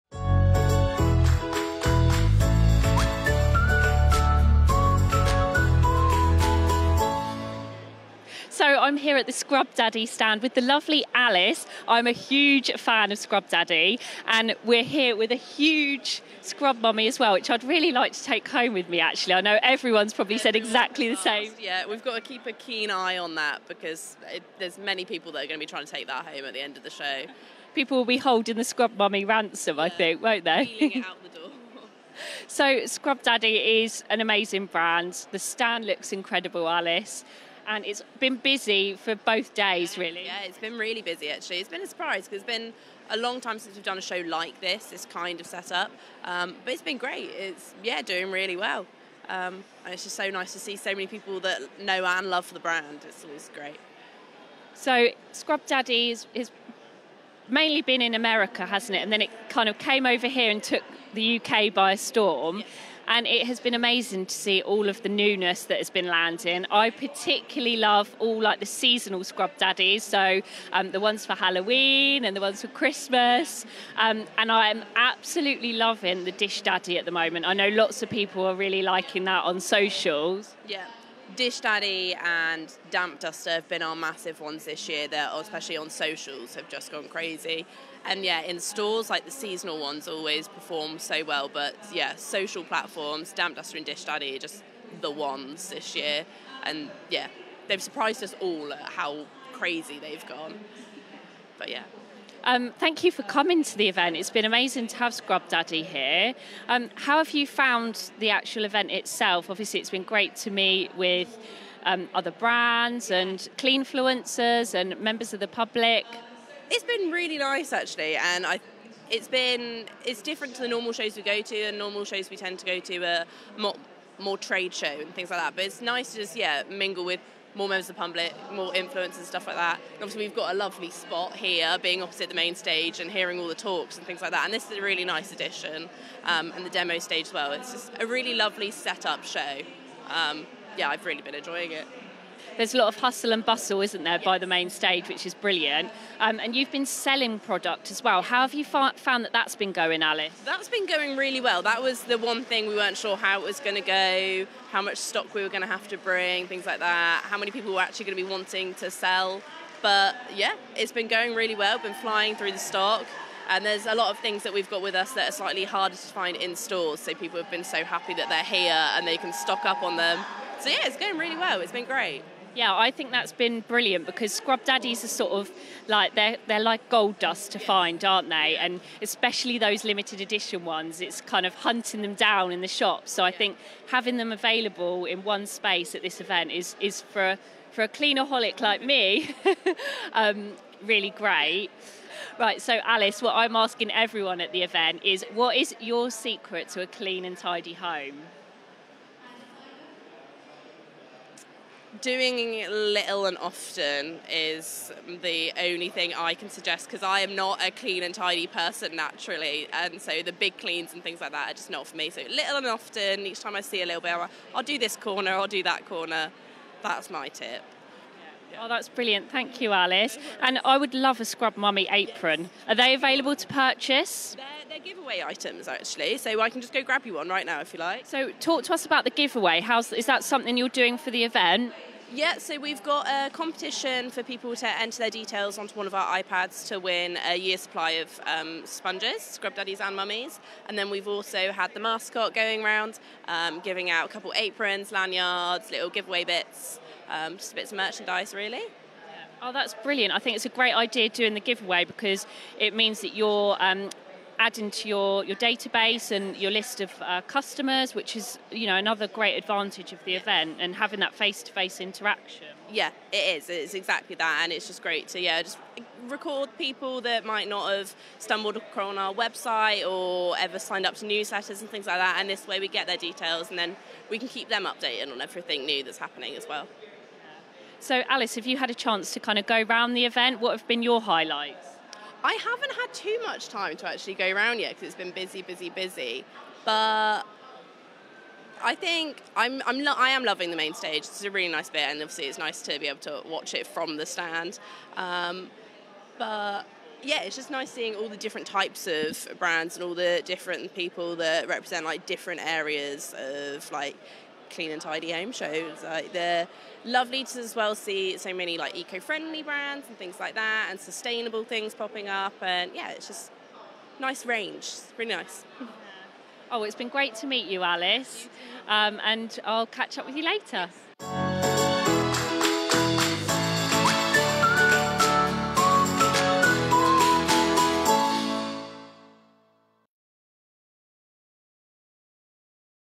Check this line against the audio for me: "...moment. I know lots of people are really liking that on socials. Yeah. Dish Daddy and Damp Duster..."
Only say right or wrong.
right.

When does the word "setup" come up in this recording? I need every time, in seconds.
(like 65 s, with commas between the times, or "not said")
45 s, 138 s.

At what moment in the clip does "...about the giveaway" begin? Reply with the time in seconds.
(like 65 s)
228 s.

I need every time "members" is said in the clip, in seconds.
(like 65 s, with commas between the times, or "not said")
114 s, 127 s.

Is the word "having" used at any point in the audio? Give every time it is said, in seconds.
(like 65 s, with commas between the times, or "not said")
183 s, 260 s.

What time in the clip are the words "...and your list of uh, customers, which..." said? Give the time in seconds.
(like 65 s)
256 s.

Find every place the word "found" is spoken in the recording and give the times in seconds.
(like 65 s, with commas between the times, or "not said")
107 s, 148 s.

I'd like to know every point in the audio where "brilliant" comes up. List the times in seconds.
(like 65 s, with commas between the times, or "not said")
145 s, 173 s, 218 s, 249 s.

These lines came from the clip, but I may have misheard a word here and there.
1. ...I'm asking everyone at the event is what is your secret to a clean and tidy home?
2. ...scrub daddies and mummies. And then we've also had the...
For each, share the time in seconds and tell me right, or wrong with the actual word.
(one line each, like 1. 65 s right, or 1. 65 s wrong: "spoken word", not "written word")
1. 193 s right
2. 239 s right.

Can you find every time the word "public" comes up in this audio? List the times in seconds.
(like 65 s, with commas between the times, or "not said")
115 s, 127 s.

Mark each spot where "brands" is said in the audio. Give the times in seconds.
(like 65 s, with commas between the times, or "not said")
34 s, 52 s, 112 s, 299 s, 309 s.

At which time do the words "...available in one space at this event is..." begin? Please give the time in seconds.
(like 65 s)
184 s.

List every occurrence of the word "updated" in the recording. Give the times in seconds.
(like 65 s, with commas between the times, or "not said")
274 s.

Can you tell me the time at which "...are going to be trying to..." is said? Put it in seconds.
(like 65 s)
25 s.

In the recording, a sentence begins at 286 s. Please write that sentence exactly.
But I think I'm, I'm lo- I am loving the main stage.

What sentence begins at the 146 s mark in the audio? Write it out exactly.
Um, and you've been selling product as well.